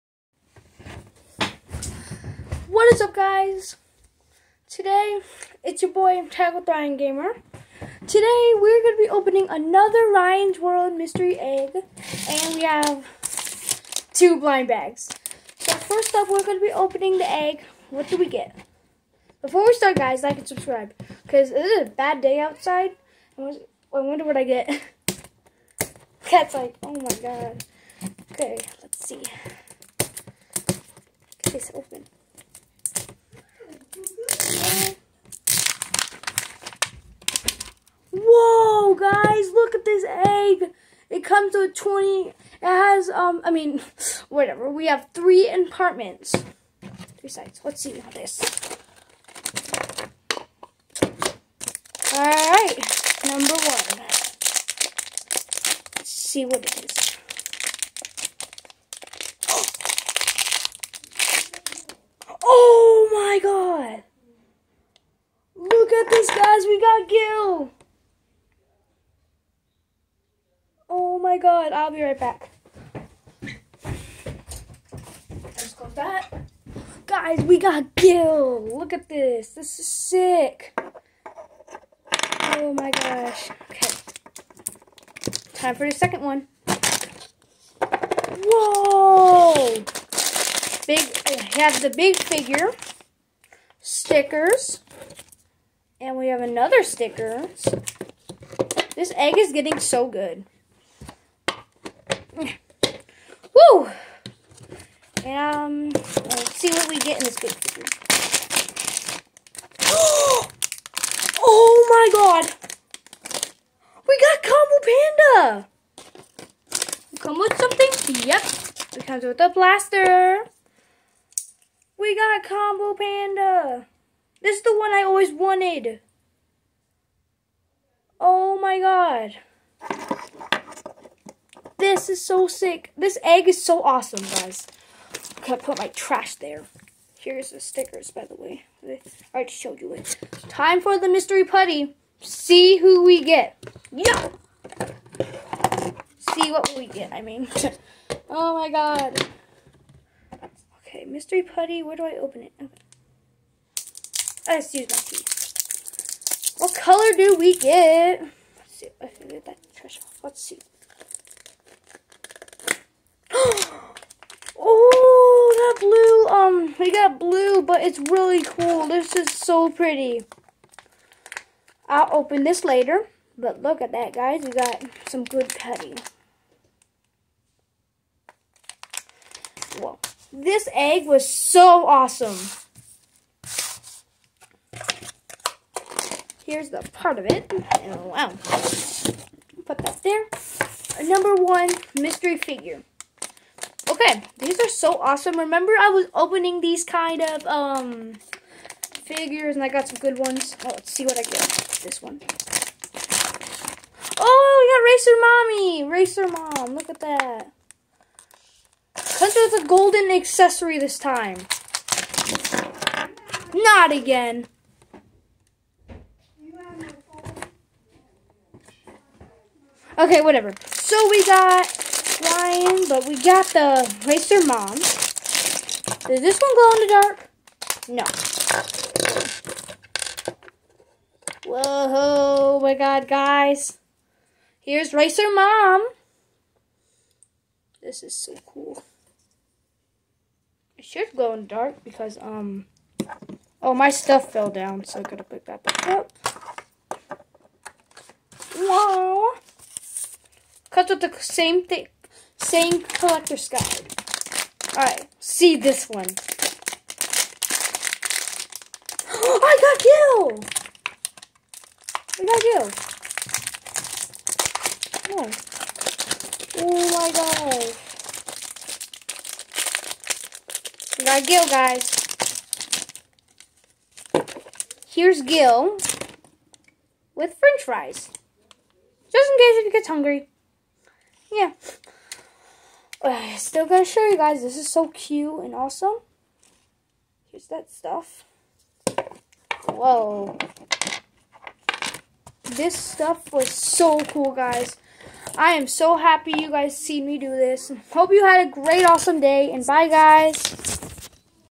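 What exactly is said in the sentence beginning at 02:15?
Okay, to put my trash there.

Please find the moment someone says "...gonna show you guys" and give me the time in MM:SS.
04:43.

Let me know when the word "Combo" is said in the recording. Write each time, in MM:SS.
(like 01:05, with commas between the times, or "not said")
01:54, 02:02.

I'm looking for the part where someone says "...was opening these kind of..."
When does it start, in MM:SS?
03:15.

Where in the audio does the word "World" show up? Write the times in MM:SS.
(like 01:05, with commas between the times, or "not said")
00:10.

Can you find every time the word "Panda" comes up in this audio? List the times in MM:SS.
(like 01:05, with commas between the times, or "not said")
01:55, 02:02.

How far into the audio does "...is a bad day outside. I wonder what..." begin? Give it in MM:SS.
00:21.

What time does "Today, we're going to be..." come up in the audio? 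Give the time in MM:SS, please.
00:08.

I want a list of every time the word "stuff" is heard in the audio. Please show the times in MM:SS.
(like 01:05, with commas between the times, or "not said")
04:03, 04:47, 04:52.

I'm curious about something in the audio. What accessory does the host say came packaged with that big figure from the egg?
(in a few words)
A blaster.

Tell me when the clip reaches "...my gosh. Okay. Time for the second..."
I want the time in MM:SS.
01:22.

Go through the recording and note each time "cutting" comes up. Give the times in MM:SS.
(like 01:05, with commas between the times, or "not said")
02:55.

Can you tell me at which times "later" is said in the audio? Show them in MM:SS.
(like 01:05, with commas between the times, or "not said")
02:52.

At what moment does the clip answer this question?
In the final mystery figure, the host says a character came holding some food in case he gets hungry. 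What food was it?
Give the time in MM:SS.
04:37.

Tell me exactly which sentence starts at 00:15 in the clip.
So, first up, we're going to be opening the egg.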